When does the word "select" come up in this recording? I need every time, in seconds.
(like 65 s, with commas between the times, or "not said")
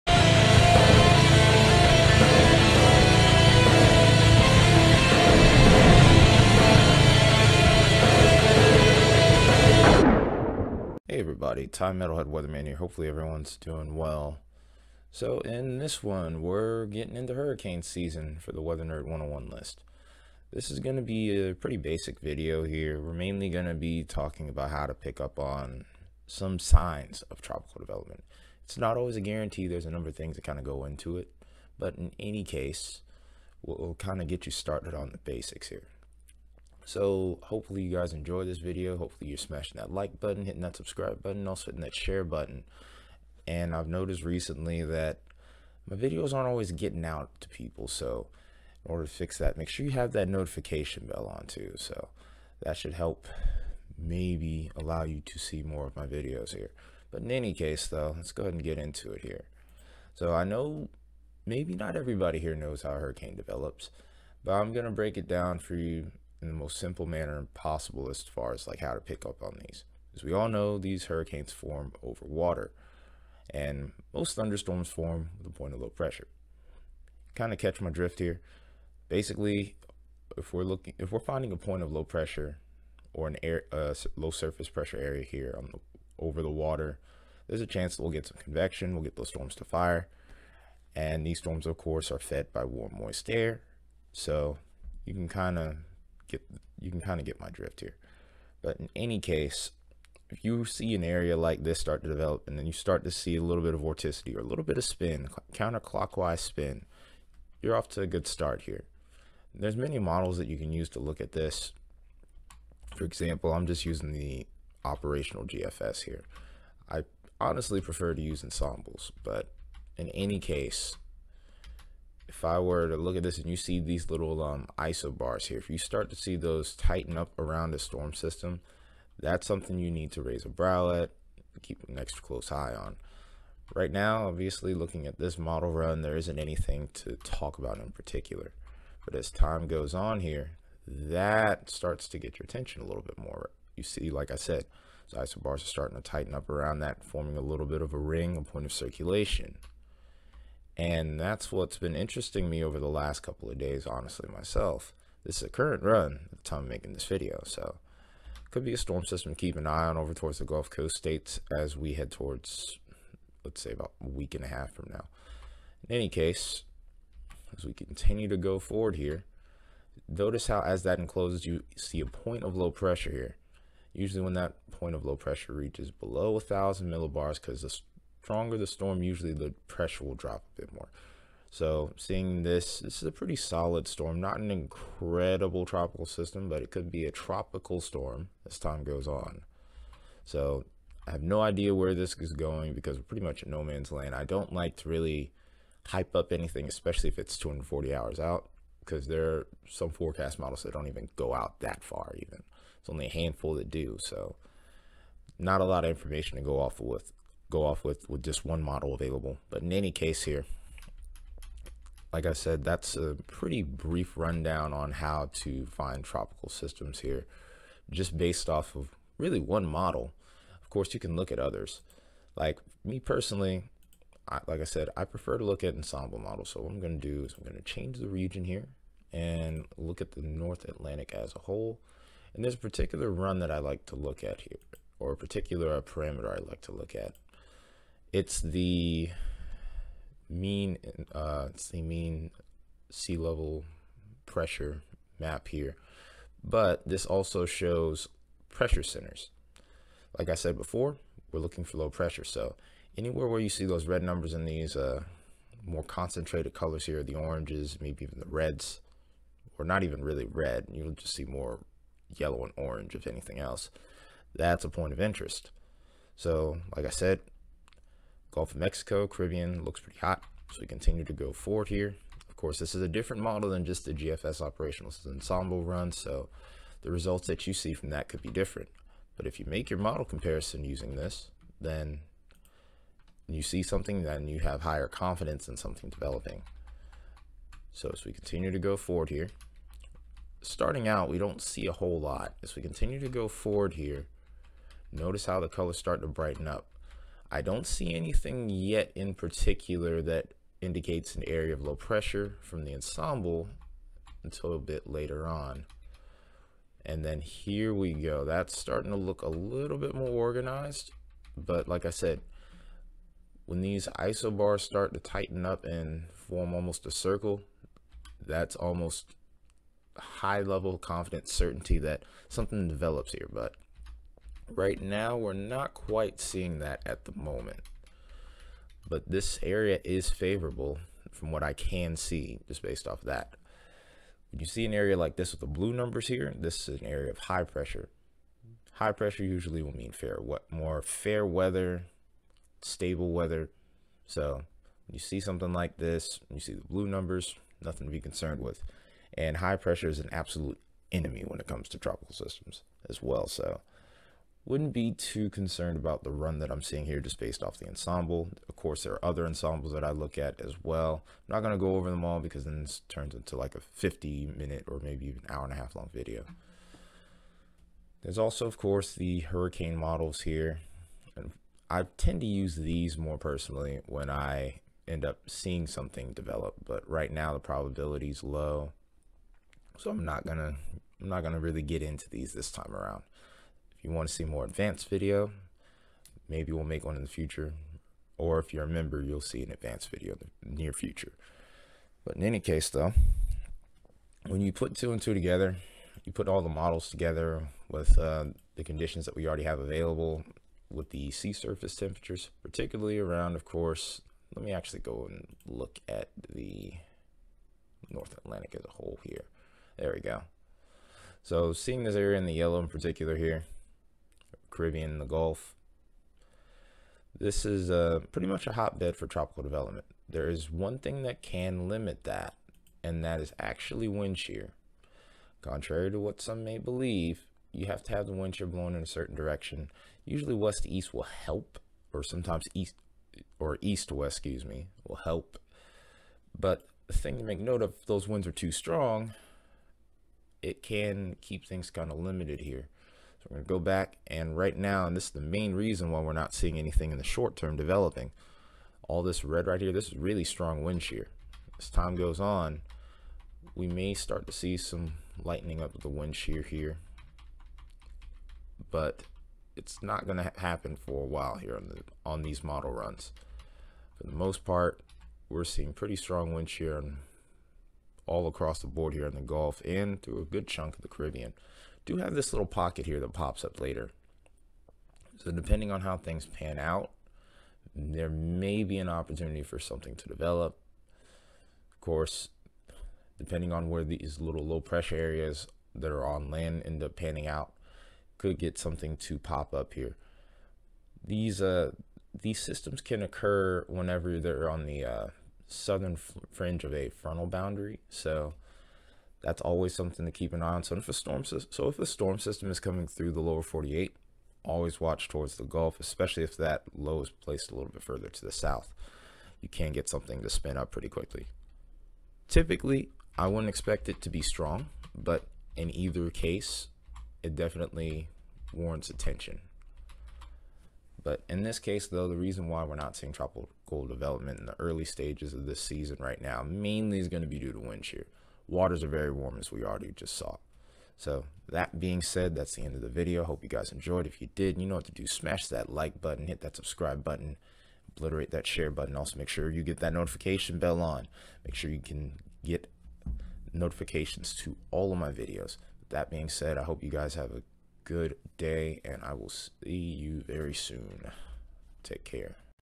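not said.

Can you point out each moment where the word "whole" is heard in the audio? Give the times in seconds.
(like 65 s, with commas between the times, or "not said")
231 s, 291 s, 408 s.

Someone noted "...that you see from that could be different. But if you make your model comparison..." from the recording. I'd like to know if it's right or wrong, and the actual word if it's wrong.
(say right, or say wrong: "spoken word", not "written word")
right.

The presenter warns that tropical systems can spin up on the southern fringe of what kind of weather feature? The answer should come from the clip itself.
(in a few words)
frontal boundary.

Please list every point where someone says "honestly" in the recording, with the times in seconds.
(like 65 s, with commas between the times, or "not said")
117 s, 153 s.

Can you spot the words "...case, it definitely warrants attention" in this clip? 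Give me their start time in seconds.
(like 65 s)
516 s.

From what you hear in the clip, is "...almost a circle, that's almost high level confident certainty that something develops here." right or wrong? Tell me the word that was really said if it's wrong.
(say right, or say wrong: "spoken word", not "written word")
right.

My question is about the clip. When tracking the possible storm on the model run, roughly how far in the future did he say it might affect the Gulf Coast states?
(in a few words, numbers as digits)
a week and a half.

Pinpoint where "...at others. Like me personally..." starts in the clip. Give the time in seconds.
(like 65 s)
221 s.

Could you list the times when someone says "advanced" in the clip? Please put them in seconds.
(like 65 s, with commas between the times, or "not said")
384 s, 389 s.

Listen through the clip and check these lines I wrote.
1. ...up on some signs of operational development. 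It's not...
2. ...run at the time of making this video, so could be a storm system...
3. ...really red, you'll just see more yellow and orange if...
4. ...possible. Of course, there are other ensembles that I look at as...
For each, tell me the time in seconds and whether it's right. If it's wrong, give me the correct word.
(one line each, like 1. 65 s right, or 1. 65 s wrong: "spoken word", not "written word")
1. 25 s wrong: "tropical", not "operational"
2. 155 s right
3. 260 s right
4. 357 s wrong: "ensemble", not "possible".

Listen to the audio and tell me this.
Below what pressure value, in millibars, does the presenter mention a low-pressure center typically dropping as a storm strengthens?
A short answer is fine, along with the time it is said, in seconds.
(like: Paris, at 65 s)
1,000 millibars, at 176 s.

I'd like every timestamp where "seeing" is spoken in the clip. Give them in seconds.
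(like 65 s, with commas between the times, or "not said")
181 s, 326 s, 356 s, 375 s, 411 s, 446 s, 465 s, 522 s.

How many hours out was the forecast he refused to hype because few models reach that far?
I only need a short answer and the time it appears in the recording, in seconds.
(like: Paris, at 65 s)
240 hours, at 197 s.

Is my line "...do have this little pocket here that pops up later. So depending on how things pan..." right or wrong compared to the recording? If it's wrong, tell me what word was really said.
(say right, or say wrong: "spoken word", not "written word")
right.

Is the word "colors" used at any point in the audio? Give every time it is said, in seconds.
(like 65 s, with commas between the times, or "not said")
256 s, 295 s.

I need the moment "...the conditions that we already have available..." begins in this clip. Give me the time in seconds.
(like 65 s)
398 s.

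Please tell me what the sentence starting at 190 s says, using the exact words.
So I have no idea where this is going because we're pretty much in no man's land.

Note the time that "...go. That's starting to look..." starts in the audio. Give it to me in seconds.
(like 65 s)
307 s.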